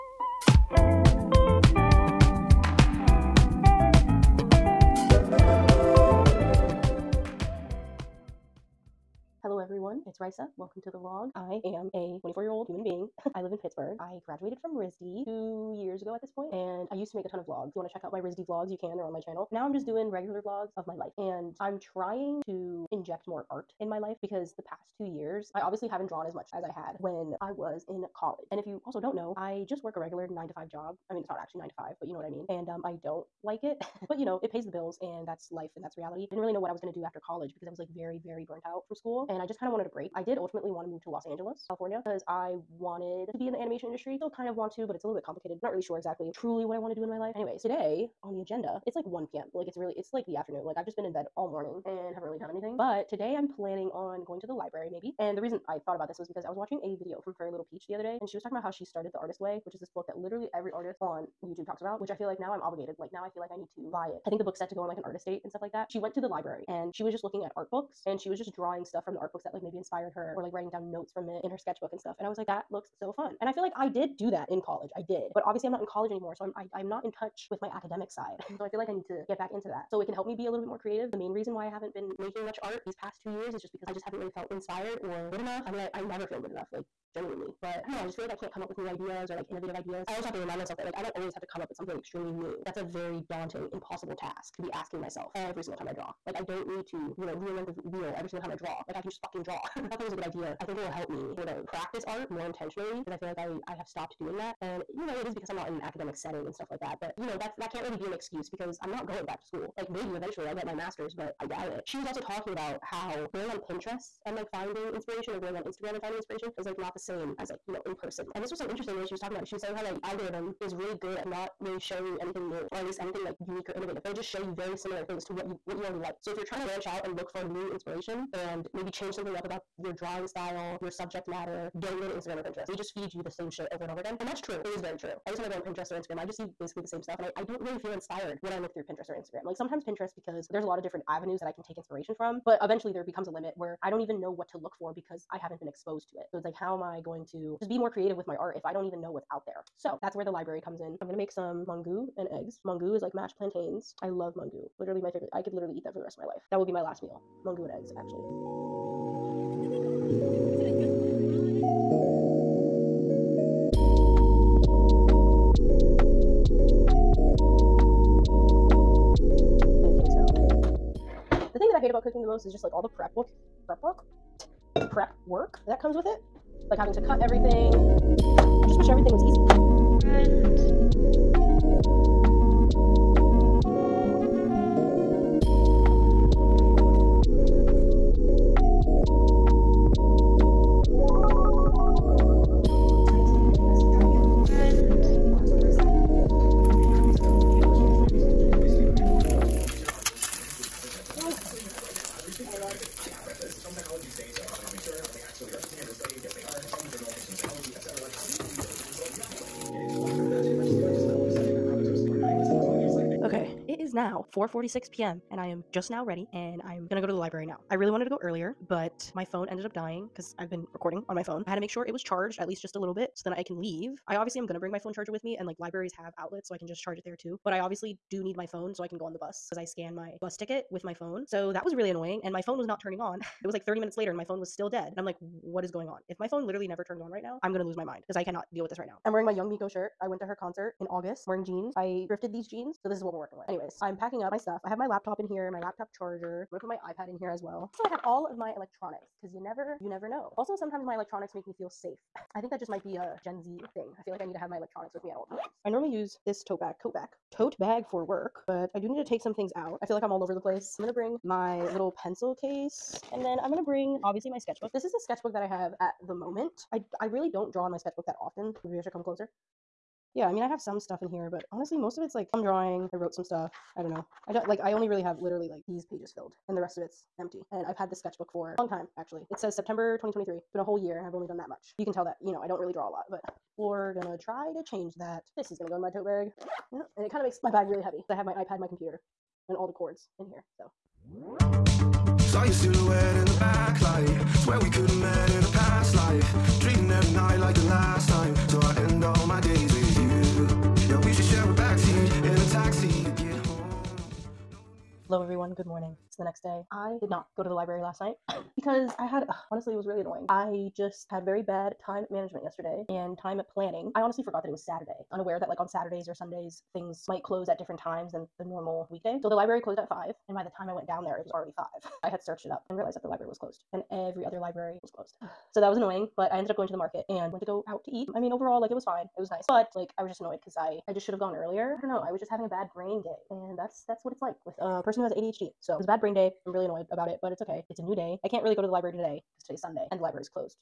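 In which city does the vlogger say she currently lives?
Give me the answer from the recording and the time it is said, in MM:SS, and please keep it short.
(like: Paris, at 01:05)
Pittsburgh, at 00:13.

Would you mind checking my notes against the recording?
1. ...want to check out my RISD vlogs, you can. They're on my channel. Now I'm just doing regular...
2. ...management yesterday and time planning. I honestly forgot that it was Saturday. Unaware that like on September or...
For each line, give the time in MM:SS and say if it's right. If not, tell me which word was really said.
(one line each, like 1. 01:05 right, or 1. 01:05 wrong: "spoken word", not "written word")
1. 00:17 right
2. 05:12 wrong: "Saturdays", not "September".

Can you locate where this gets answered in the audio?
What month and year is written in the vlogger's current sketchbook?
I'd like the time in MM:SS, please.
04:39.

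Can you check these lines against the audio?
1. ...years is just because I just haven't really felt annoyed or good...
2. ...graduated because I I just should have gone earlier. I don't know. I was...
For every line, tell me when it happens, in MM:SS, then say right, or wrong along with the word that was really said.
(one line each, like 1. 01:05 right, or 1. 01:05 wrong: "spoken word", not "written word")
1. 01:23 wrong: "inspired", not "annoyed"
2. 05:30 wrong: "annoyed", not "graduated".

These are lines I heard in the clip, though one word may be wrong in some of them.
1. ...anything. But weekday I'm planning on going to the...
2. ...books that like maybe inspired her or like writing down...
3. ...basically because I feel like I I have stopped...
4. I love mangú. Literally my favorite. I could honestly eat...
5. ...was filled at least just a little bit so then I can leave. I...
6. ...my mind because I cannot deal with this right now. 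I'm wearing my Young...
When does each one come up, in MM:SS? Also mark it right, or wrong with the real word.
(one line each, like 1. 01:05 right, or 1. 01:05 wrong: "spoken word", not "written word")
1. 00:52 wrong: "today", not "weekday"
2. 01:09 right
3. 01:42 wrong: "intentionally", not "basically"
4. 02:34 wrong: "literally", not "honestly"
5. 03:41 wrong: "charged", not "filled"
6. 03:57 right.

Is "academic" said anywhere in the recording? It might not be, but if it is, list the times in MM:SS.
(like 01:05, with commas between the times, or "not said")
01:17, 01:45.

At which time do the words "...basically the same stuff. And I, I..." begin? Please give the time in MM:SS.
02:16.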